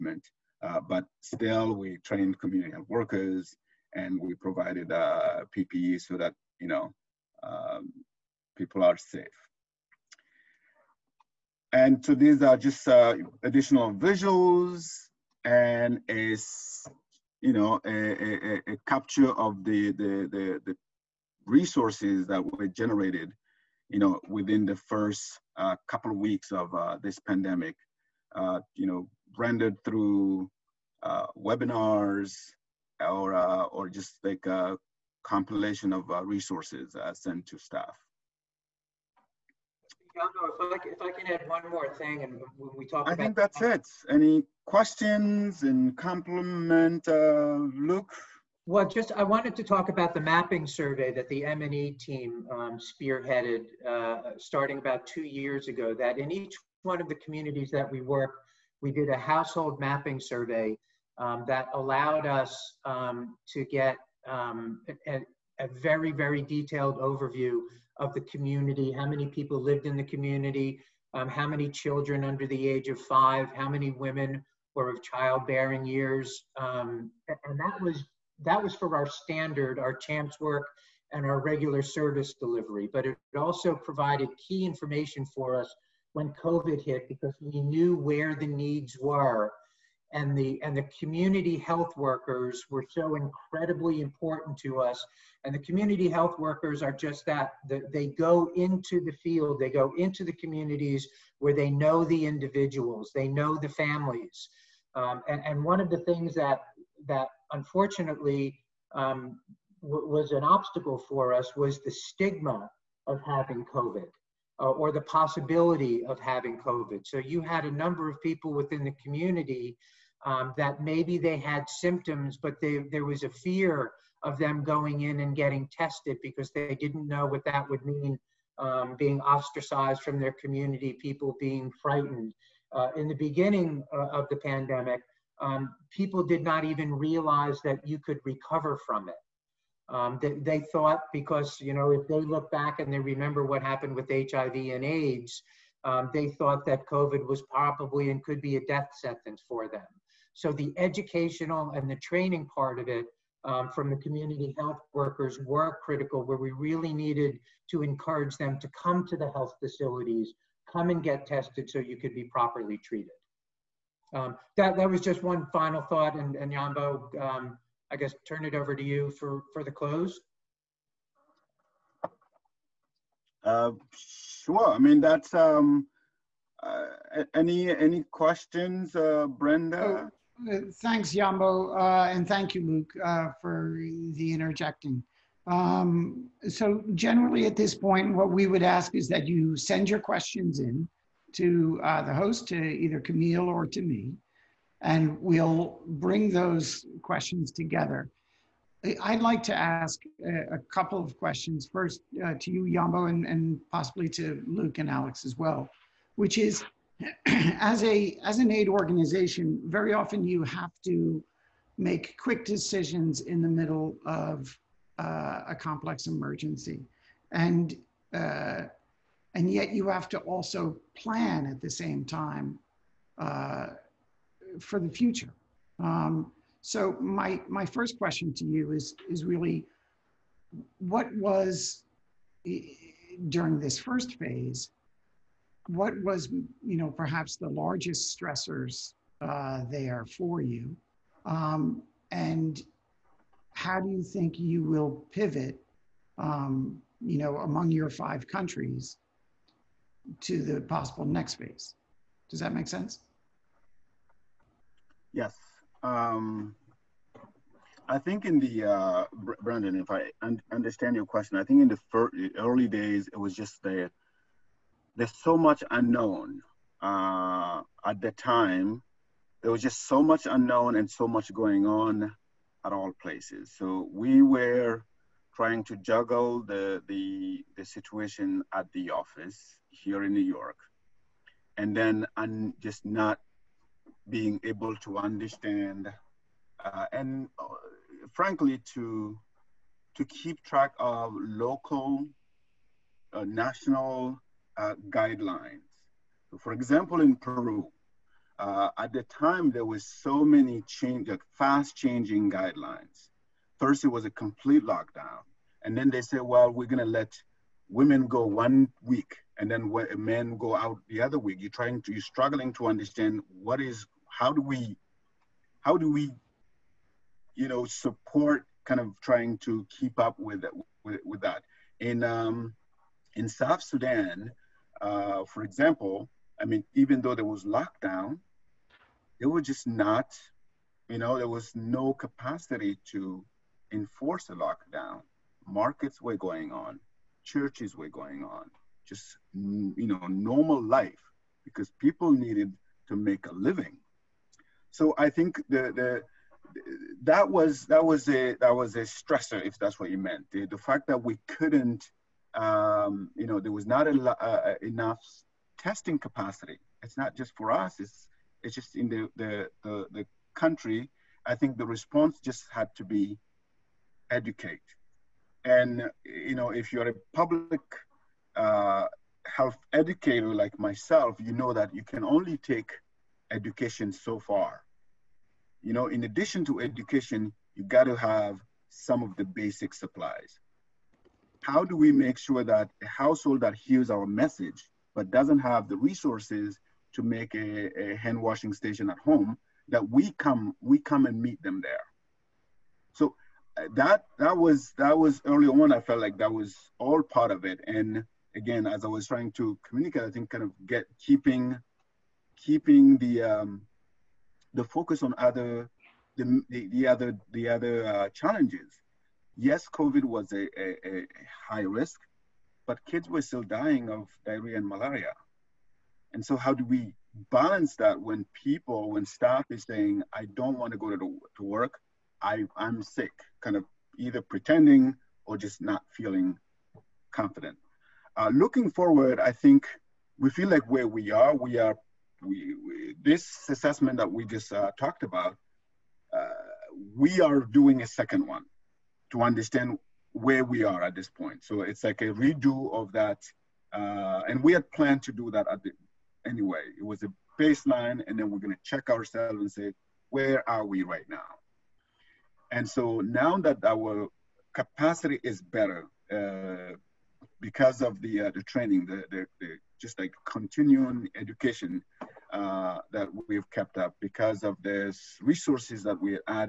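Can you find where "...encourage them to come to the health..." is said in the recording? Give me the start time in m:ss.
2:37.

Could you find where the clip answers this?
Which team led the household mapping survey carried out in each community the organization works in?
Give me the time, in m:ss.
0:51.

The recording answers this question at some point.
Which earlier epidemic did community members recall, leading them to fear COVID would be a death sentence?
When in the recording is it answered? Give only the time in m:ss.
2:24.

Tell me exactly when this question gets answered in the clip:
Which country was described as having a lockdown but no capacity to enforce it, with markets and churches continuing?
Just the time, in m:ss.
5:23.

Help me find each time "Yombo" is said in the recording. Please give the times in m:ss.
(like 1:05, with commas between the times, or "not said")
2:46, 3:01, 3:22.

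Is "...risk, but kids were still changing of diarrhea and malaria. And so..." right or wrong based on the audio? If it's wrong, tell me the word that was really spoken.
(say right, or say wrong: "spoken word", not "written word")
wrong: "dying", not "changing".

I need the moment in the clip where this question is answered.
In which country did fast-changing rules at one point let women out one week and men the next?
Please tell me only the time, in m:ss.
4:57.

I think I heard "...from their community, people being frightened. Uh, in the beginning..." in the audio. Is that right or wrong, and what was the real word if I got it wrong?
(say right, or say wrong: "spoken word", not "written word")
right.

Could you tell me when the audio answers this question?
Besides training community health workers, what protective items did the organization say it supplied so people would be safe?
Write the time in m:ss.
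0:05.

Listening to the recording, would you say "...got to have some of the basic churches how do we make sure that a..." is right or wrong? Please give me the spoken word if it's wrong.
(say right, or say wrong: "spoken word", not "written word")
wrong: "supplies", not "churches".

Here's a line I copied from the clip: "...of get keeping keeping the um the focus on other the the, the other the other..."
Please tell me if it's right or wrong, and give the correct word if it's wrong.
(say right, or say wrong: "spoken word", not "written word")
right.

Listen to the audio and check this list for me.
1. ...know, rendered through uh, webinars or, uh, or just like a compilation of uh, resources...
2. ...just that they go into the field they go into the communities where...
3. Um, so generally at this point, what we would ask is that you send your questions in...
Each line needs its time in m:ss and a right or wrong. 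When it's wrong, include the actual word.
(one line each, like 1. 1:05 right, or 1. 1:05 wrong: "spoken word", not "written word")
1. 0:28 right
2. 1:36 right
3. 3:05 right.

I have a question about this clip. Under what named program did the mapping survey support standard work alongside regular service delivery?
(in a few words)
CHAMPS.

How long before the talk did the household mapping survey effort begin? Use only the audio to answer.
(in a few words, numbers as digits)
about two years ago.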